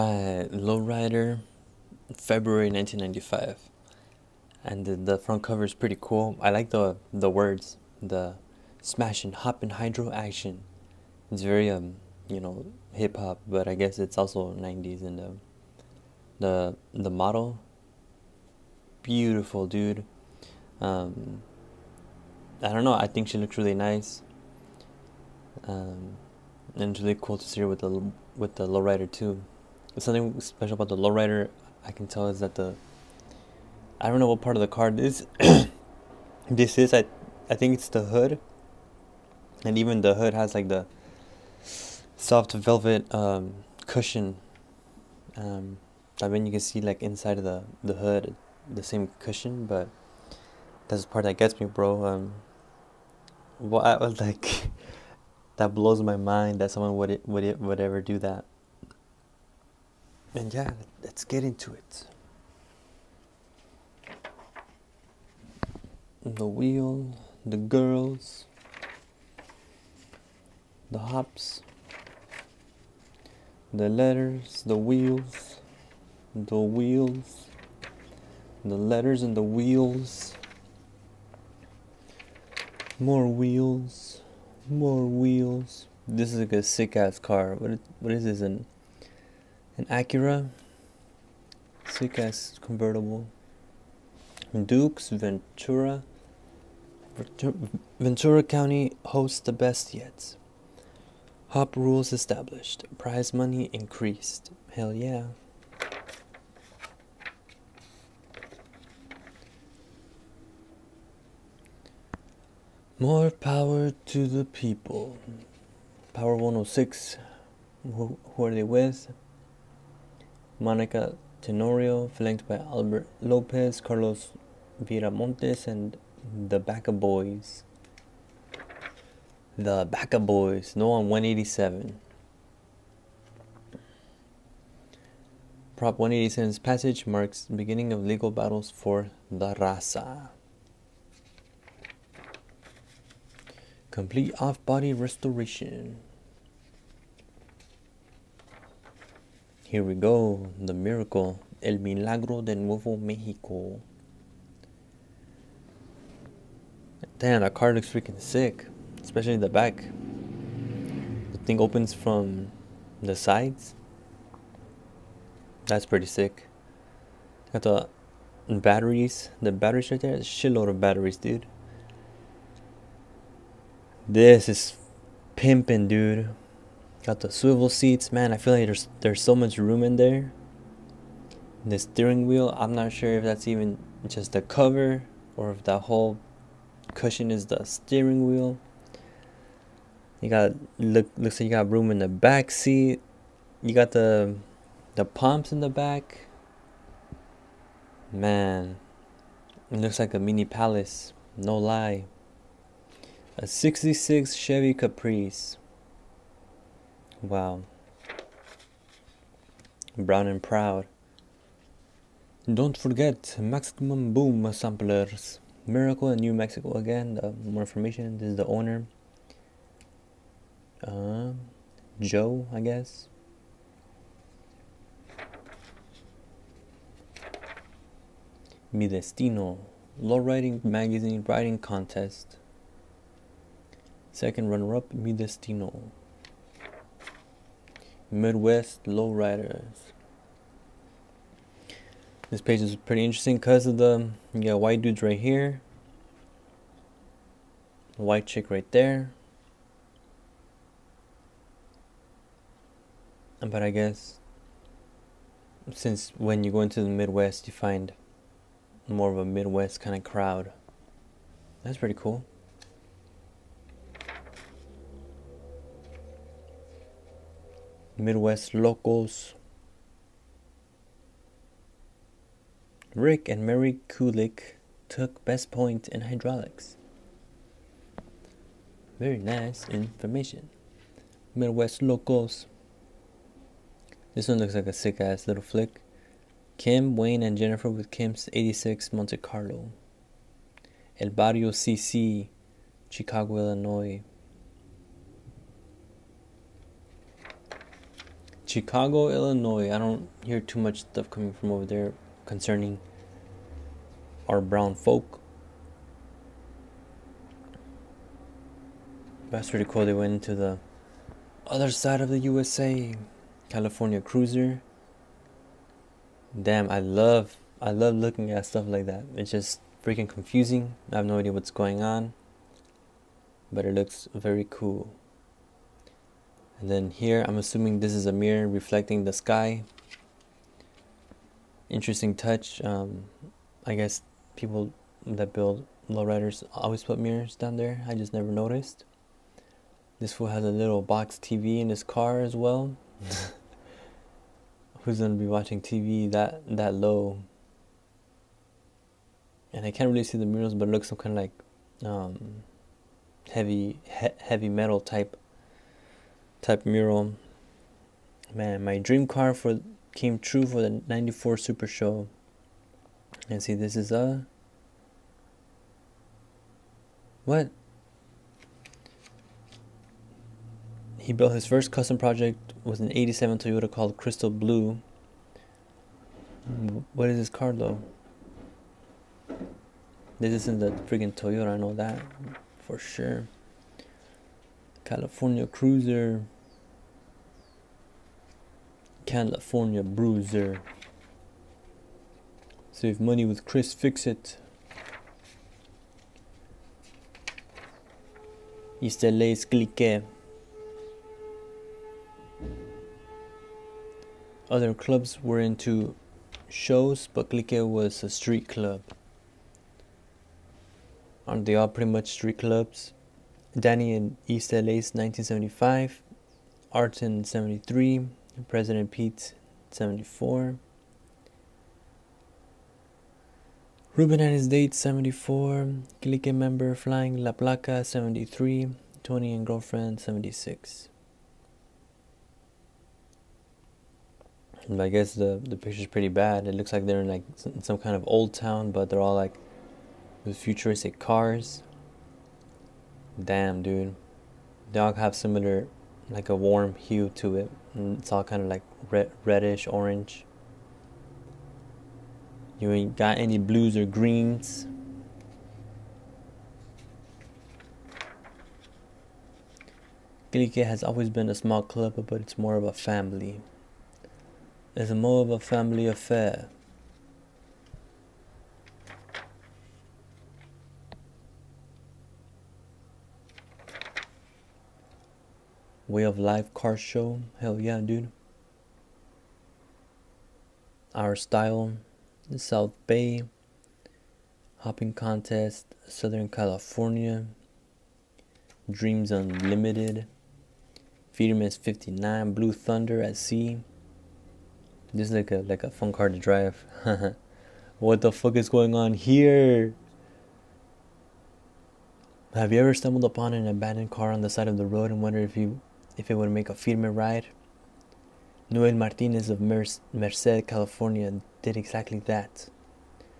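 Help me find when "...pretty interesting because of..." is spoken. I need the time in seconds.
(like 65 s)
242 s.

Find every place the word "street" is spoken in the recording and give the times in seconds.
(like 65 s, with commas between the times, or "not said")
408 s, 412 s.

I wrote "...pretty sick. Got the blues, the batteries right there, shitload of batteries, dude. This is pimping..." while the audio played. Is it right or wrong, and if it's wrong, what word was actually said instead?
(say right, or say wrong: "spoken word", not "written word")
wrong: "batteries", not "blues".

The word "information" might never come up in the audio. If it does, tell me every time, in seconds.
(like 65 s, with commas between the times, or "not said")
217 s, 279 s.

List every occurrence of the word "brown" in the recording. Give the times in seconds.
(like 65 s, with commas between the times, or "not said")
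209 s, 304 s.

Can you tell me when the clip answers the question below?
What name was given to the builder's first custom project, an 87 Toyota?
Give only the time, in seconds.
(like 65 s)
373 s.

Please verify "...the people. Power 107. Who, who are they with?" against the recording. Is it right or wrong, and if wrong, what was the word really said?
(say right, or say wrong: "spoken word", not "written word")
wrong: "106", not "107".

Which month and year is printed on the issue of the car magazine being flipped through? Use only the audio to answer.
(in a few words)
February 1995.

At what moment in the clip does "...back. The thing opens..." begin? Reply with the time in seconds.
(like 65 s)
159 s.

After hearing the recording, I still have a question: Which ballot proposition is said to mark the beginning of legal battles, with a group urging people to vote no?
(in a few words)
Prop 187.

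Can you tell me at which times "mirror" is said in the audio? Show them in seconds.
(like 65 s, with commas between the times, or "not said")
328 s, 336 s.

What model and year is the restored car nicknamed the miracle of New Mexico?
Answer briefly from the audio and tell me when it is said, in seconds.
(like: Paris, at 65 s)
66 Chevy Caprice, at 203 s.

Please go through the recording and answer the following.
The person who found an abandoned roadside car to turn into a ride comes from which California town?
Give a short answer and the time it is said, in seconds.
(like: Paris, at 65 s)
Merced, at 509 s.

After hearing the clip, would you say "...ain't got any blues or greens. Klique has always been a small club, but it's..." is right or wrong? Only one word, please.
right.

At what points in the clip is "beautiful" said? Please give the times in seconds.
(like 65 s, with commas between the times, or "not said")
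19 s.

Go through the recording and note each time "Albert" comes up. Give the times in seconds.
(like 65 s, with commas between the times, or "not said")
122 s.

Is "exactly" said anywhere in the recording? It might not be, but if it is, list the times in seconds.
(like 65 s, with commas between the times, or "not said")
511 s.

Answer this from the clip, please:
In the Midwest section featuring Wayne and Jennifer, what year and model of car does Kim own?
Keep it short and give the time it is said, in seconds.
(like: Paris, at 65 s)
86 Monte Carlo, at 288 s.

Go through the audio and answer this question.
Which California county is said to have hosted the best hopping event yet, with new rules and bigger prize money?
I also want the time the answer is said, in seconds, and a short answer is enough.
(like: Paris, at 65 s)
Ventura County, at 97 s.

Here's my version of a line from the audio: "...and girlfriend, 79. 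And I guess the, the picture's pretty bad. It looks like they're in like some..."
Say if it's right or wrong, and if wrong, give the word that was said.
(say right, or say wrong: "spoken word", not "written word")
wrong: "76", not "79".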